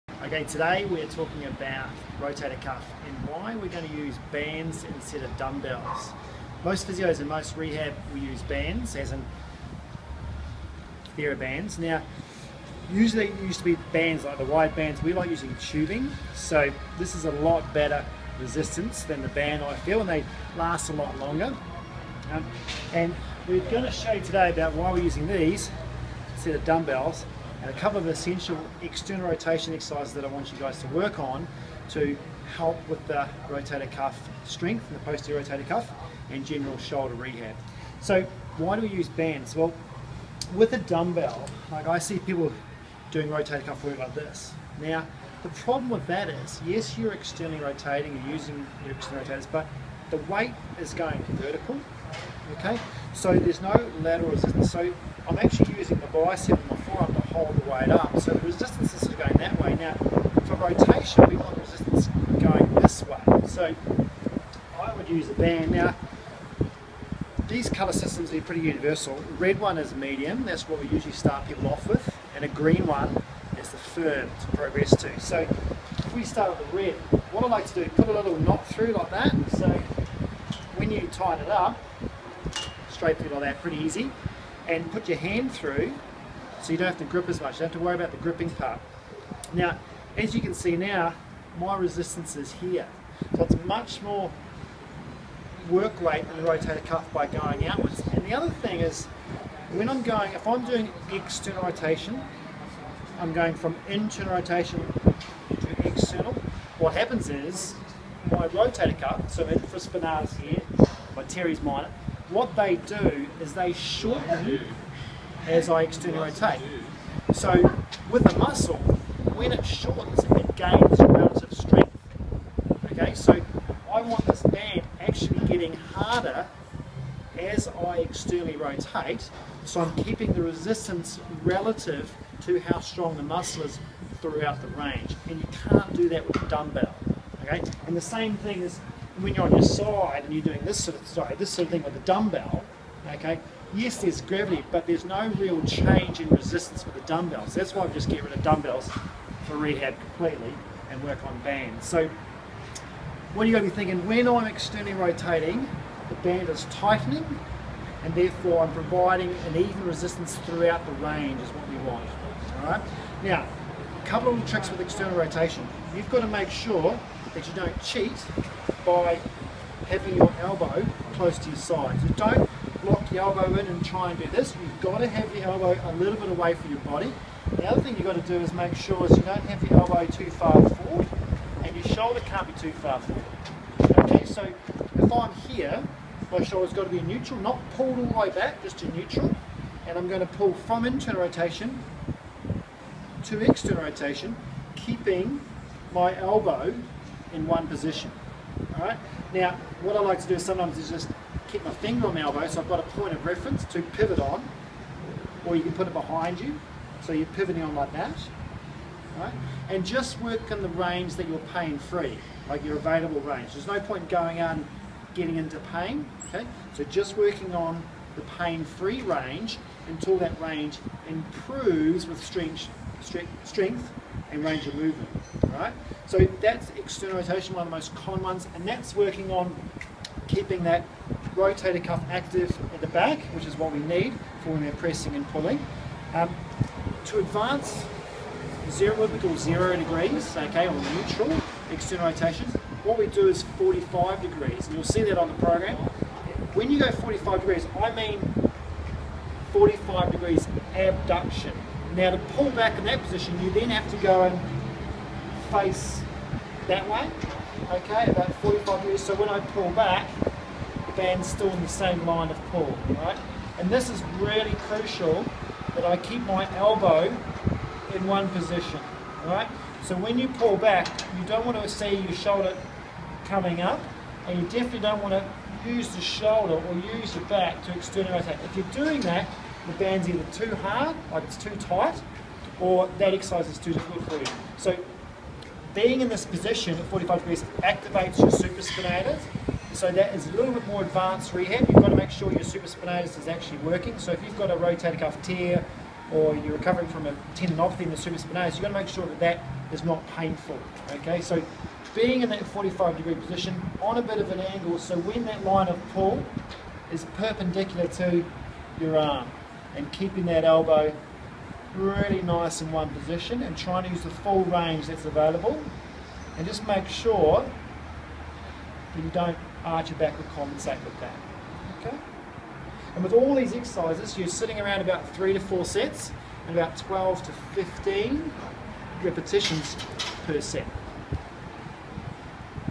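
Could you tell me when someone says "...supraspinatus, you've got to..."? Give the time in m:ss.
4:57.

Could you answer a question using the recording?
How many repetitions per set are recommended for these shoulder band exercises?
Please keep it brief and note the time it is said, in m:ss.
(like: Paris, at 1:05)
12 to 15, at 5:26.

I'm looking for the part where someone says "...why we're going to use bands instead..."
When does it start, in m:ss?
0:03.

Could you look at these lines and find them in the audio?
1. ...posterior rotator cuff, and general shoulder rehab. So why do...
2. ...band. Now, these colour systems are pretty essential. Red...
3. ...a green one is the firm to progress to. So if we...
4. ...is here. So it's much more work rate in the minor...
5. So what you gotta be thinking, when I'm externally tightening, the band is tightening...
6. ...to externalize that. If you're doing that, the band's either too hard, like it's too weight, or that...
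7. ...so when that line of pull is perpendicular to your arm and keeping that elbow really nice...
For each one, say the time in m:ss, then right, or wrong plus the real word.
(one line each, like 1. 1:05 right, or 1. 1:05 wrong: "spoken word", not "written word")
1. 0:35 right
2. 1:05 wrong: "universal", not "essential"
3. 1:12 right
4. 1:32 wrong: "rotator", not "minor"
5. 2:31 wrong: "rotating", not "tightening"
6. 4:37 wrong: "tight", not "weight"
7. 5:04 right.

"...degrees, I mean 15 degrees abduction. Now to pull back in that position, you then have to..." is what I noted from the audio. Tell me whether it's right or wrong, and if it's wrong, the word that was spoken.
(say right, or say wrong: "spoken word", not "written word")
wrong: "45", not "15".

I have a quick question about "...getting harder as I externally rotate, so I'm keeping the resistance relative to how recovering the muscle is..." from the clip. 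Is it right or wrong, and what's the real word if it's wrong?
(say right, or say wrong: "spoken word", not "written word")
wrong: "strong", not "recovering".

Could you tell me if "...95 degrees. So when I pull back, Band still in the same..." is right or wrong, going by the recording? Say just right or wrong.
wrong.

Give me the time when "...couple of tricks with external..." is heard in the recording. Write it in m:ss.
2:44.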